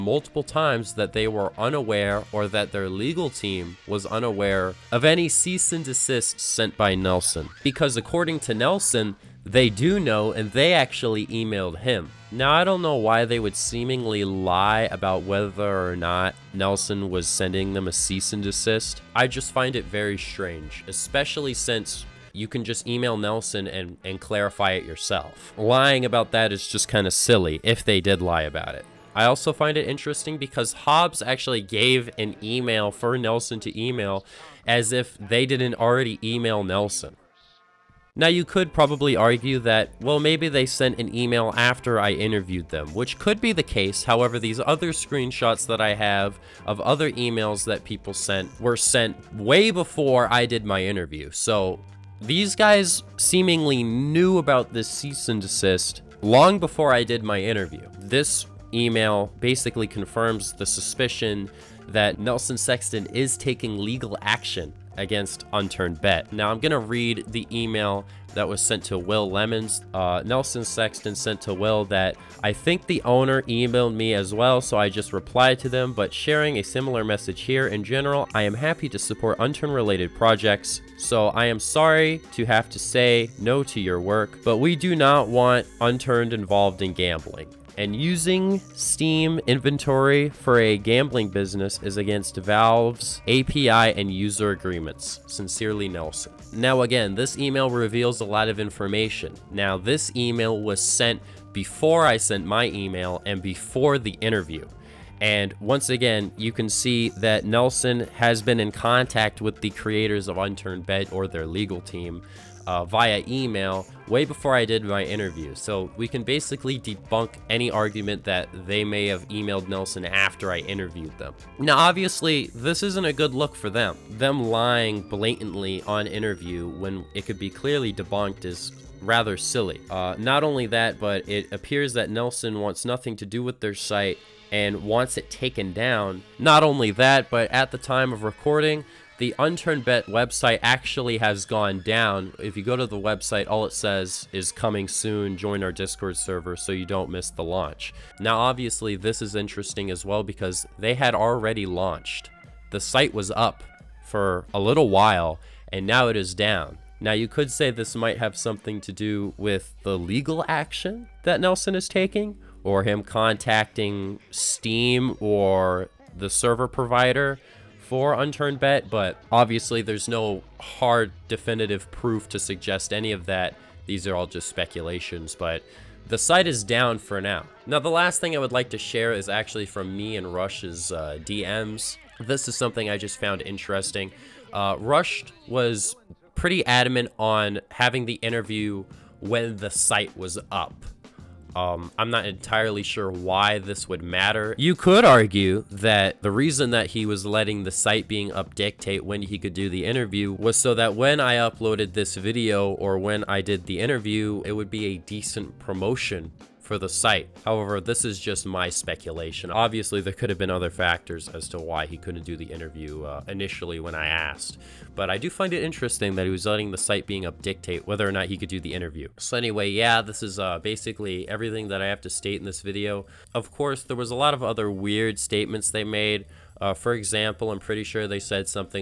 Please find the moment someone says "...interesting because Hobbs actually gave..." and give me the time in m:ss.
0:29.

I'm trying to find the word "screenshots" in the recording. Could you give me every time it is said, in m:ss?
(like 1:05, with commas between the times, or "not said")
0:44.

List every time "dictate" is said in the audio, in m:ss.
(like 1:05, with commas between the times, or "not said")
3:18, 3:37.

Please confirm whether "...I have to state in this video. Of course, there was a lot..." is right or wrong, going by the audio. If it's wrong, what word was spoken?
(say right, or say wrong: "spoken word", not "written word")
right.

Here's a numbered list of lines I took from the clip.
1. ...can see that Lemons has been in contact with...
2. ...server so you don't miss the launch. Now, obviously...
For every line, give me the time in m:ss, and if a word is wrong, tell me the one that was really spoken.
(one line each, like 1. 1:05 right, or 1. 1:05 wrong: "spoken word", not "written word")
1. 1:46 wrong: "Nelson", not "Lemons"
2. 2:26 right.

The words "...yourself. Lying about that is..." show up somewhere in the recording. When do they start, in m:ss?
0:24.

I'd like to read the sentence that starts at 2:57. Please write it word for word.
Now, the last thing I would like to share is actually from me and Rush's uh, DMs.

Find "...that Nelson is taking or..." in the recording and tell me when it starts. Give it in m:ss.
2:41.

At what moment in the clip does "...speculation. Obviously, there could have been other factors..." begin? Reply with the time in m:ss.
3:28.